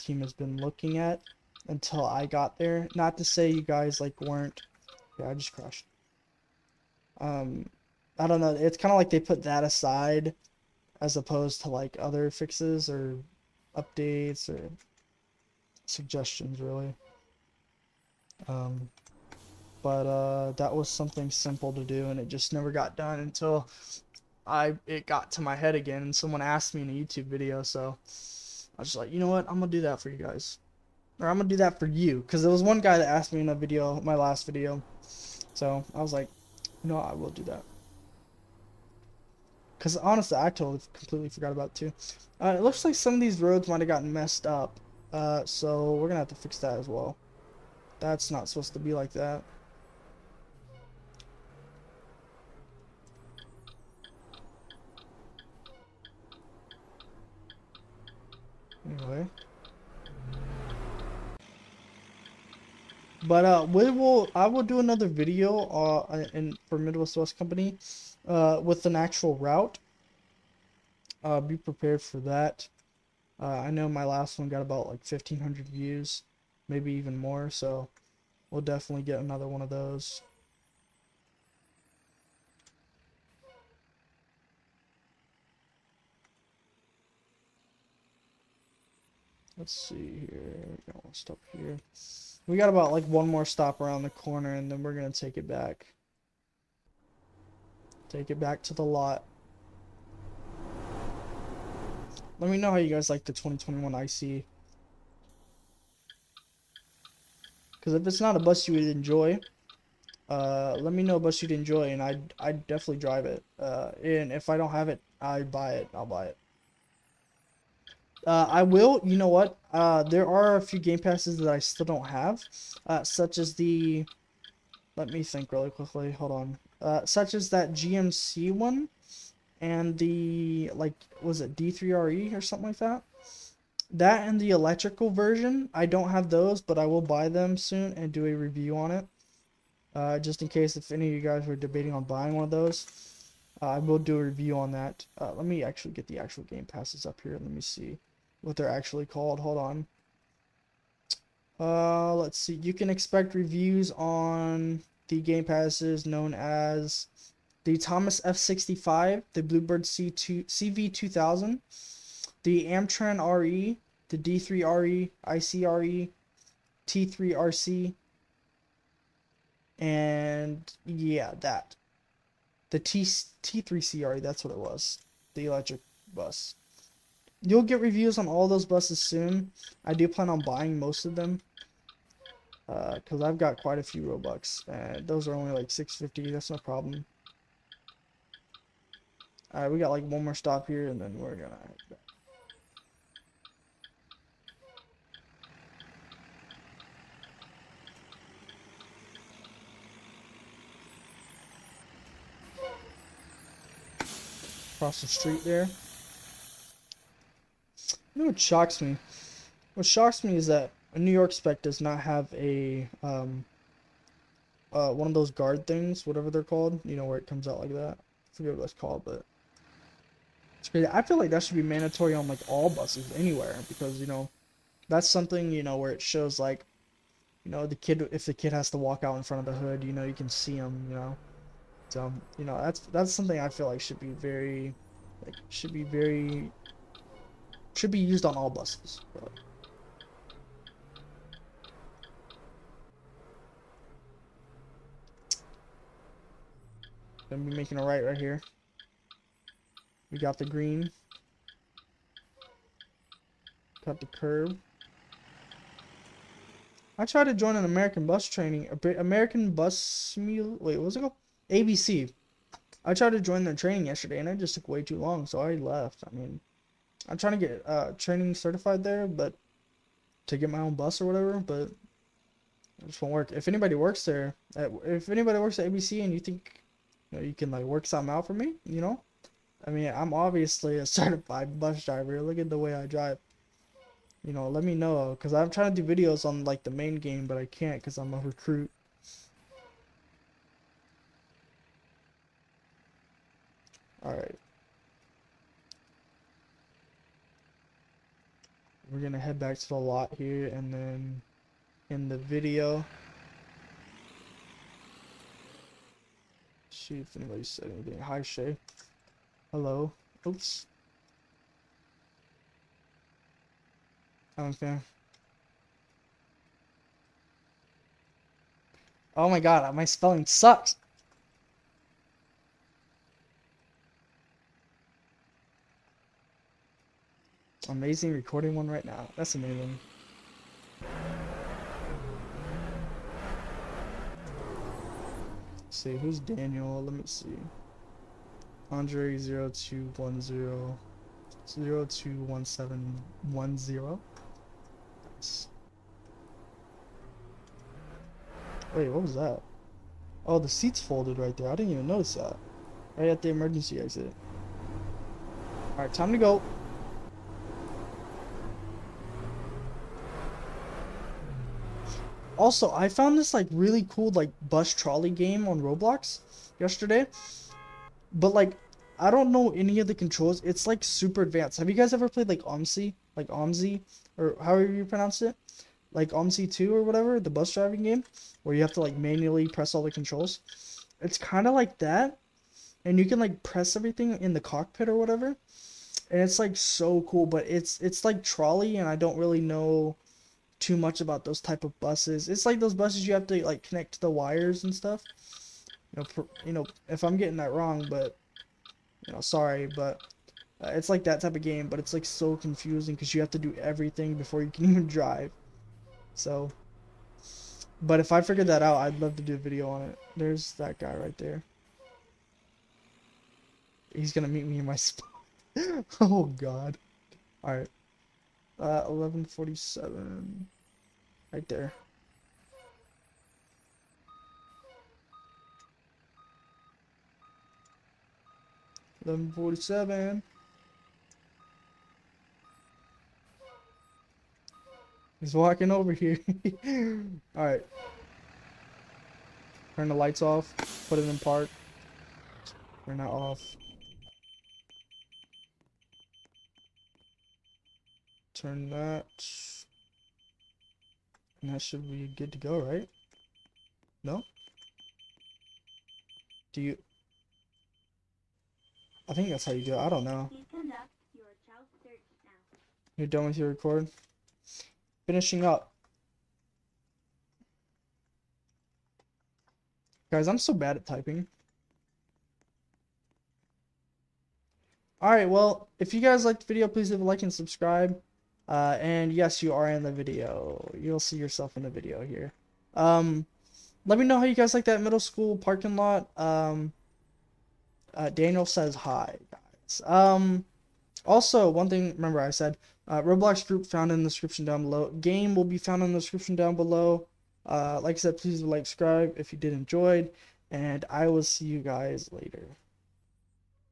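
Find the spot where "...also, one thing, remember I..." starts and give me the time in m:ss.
8:11.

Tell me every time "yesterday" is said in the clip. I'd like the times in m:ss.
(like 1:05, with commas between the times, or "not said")
4:23, 6:06.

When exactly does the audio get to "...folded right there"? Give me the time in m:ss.
5:50.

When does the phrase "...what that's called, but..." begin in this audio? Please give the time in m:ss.
3:38.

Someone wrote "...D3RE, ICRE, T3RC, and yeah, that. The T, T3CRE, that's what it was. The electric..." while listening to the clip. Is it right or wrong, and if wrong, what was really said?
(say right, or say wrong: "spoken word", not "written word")
right.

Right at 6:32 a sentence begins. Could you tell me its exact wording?
It's like those buses you have to like connect to the wires and stuff.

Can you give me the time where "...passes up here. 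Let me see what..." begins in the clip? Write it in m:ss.
2:26.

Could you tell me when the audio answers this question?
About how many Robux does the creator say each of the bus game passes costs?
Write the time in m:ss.
3:05.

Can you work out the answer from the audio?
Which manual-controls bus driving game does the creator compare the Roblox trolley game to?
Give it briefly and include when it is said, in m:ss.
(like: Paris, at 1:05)
OMSI 2, at 6:16.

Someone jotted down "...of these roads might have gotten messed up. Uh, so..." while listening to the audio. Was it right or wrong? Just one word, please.
right.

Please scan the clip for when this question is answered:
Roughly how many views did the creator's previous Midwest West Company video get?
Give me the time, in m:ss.
1:15.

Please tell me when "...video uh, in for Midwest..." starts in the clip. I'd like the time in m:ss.
1:05.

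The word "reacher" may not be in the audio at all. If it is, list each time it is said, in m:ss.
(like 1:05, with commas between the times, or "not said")
not said.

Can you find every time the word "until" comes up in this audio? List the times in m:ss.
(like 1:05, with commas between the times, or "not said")
0:01, 0:23.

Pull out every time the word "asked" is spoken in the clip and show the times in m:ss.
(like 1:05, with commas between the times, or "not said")
0:26, 0:33.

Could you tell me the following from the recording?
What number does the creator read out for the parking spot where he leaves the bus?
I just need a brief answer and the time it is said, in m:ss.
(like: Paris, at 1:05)
1147, at 6:58.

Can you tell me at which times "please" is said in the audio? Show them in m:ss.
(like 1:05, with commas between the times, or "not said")
7:56, 8:18.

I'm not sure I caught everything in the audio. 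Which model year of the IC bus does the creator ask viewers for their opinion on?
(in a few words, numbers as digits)
2021.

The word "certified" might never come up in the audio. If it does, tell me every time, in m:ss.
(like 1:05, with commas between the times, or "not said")
4:28, 4:40.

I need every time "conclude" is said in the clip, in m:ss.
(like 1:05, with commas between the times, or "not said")
not said.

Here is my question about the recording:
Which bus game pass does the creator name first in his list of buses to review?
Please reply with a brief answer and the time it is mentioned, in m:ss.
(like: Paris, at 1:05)
Thomas F65, at 2:37.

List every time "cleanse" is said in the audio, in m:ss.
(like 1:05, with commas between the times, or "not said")
not said.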